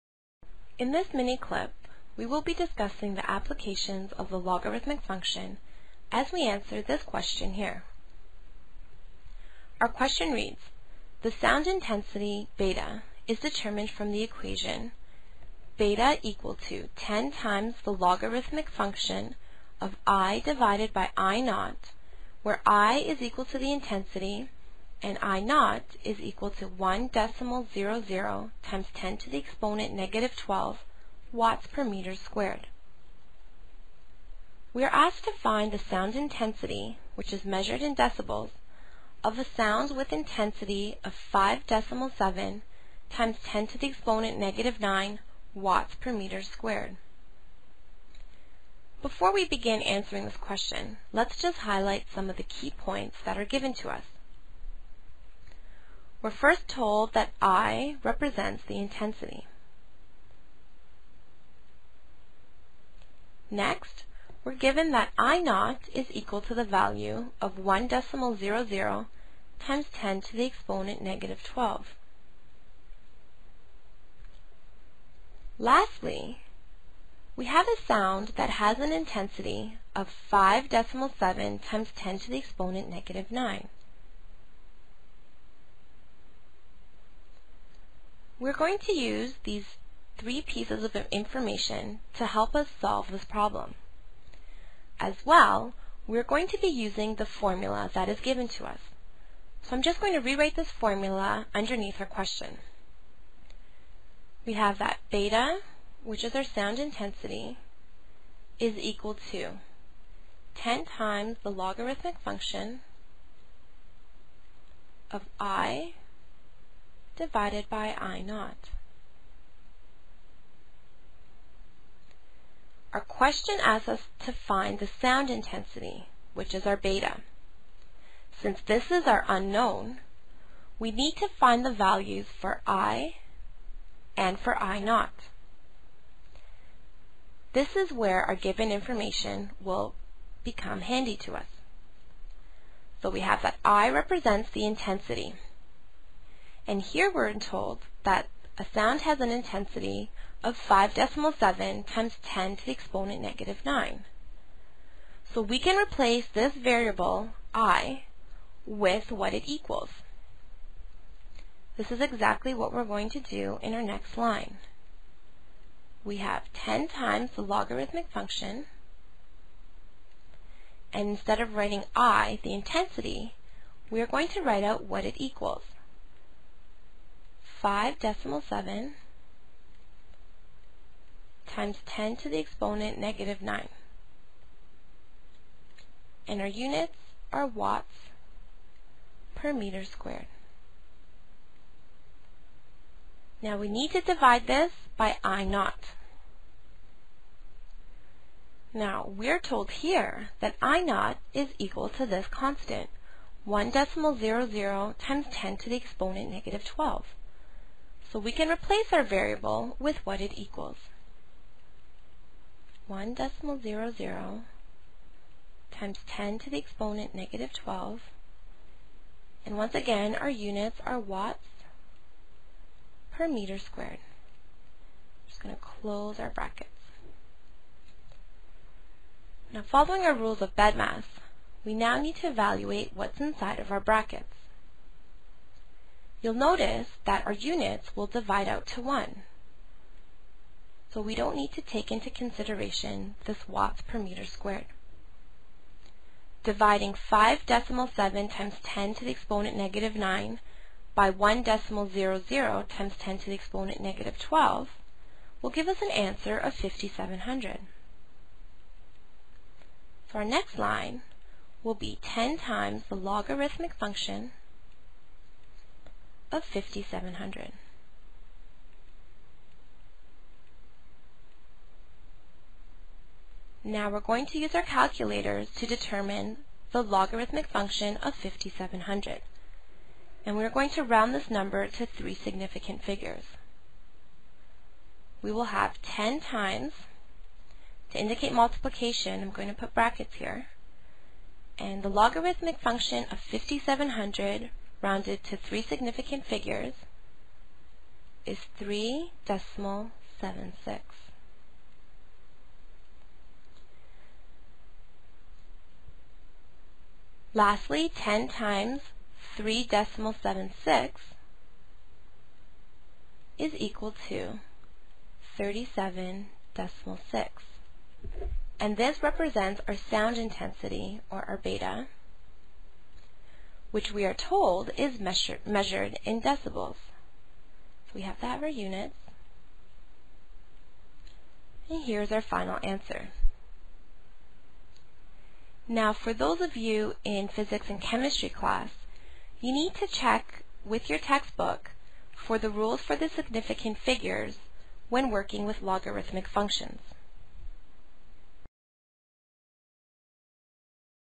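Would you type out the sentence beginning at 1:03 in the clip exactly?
Next, we're given that I0 is equal to the value of 1.00 decimal times 10 to the exponent negative 12.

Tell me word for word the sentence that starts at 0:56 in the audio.
We're first told that I represents the intensity.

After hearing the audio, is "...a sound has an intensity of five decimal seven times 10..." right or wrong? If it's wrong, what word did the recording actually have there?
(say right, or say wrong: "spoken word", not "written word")
right.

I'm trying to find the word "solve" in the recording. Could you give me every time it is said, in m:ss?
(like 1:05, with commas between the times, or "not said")
1:32.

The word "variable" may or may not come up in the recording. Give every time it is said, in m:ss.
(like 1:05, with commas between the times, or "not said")
2:36, 3:29.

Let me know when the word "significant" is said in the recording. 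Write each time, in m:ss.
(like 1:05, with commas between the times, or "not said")
4:42, 4:55, 5:43.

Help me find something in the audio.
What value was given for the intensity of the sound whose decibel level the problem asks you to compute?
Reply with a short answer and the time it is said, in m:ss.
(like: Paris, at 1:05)
5.7 × 10^-9 W/m², at 0:41.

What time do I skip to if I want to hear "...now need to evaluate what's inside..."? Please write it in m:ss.
3:51.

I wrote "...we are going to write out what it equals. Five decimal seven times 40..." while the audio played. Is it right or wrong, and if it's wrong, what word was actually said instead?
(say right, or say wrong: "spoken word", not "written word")
wrong: "10", not "40".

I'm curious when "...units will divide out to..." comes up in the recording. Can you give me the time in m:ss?
3:57.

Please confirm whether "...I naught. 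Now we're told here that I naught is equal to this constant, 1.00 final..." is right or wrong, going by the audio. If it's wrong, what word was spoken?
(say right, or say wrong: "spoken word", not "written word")
wrong: "decimal", not "final".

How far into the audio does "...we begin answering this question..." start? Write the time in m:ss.
0:49.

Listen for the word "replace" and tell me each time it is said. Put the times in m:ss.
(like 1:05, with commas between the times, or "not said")
2:35, 3:28.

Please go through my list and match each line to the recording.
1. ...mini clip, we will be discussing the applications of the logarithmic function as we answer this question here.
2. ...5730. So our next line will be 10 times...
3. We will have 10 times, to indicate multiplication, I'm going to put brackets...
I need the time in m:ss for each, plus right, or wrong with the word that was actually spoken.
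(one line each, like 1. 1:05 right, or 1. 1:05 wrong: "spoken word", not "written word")
1. 0:01 right
2. 4:16 wrong: "5700", not "5730"
3. 4:45 right.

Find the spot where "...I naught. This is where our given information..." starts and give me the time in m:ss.
2:14.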